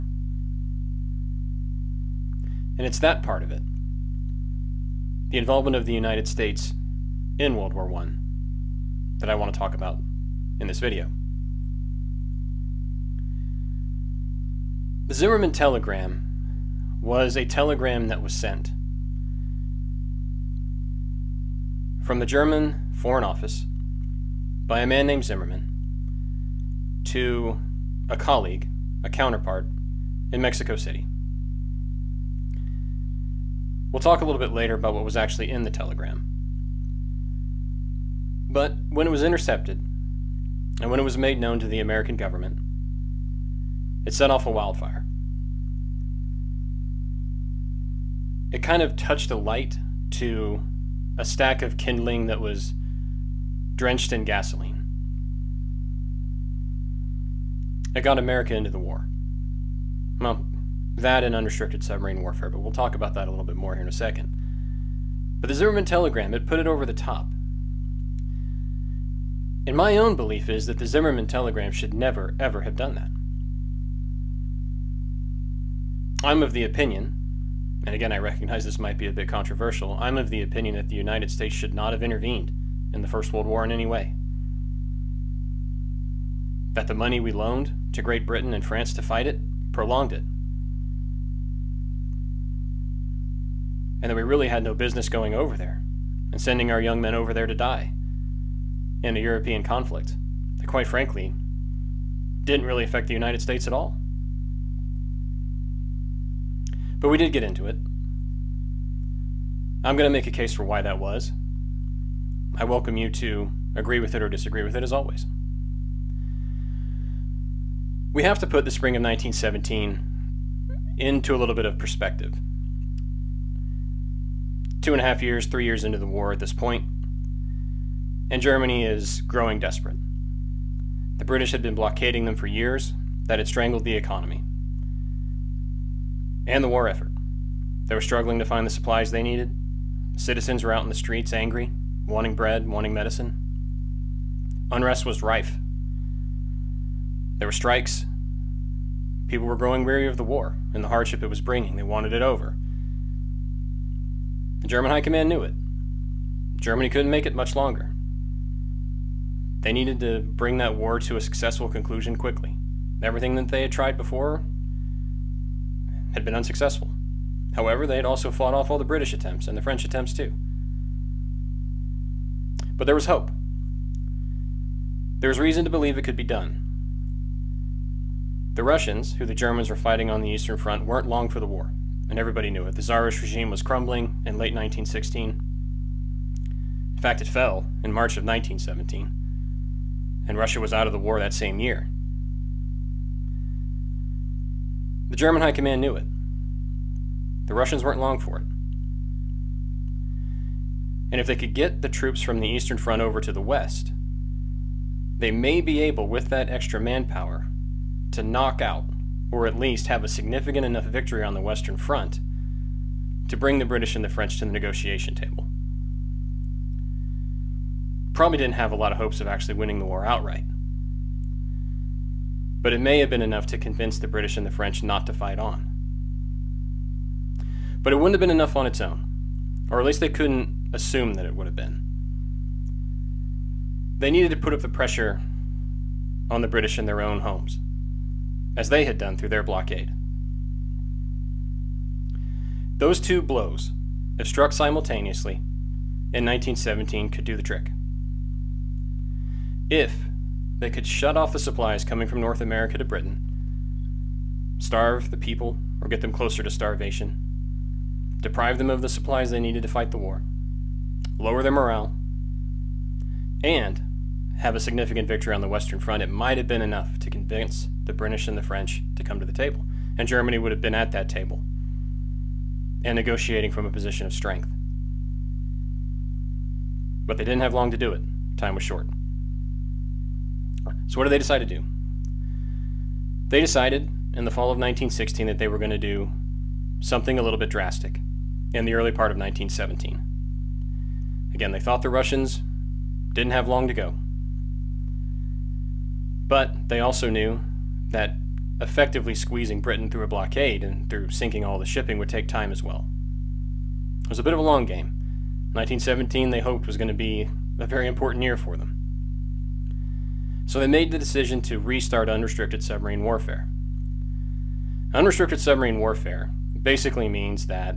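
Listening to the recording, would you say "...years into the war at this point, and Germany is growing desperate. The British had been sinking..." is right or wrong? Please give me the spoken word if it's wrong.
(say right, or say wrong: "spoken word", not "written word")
wrong: "blockading", not "sinking".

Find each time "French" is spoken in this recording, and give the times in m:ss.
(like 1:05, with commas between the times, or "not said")
2:49, 3:34, 3:44, 4:28.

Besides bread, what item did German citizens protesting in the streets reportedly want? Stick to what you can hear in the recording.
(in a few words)
Medicine.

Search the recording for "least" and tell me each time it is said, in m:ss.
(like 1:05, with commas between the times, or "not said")
3:29, 3:49.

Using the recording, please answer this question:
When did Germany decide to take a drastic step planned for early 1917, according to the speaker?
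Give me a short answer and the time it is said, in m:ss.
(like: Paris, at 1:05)
Fall of 1916, at 4:44.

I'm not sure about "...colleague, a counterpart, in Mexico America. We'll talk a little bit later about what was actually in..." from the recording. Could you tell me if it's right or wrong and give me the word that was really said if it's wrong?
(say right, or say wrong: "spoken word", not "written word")
wrong: "City", not "America".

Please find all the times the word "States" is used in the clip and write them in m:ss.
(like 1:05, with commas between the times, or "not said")
0:06, 1:21, 1:43.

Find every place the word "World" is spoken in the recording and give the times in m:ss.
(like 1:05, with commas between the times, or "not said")
0:07, 1:23.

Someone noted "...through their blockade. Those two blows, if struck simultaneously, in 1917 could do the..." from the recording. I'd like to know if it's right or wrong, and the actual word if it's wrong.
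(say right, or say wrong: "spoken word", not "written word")
right.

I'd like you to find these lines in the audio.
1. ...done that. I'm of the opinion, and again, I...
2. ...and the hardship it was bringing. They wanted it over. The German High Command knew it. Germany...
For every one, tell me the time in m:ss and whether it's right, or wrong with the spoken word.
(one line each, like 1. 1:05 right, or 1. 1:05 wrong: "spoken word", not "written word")
1. 1:12 right
2. 2:30 right.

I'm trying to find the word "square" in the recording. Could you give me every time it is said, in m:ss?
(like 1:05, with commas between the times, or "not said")
not said.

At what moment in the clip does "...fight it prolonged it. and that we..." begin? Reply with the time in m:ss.
1:29.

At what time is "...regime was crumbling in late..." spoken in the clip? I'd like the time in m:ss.
3:03.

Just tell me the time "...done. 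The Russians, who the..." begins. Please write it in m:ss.
2:56.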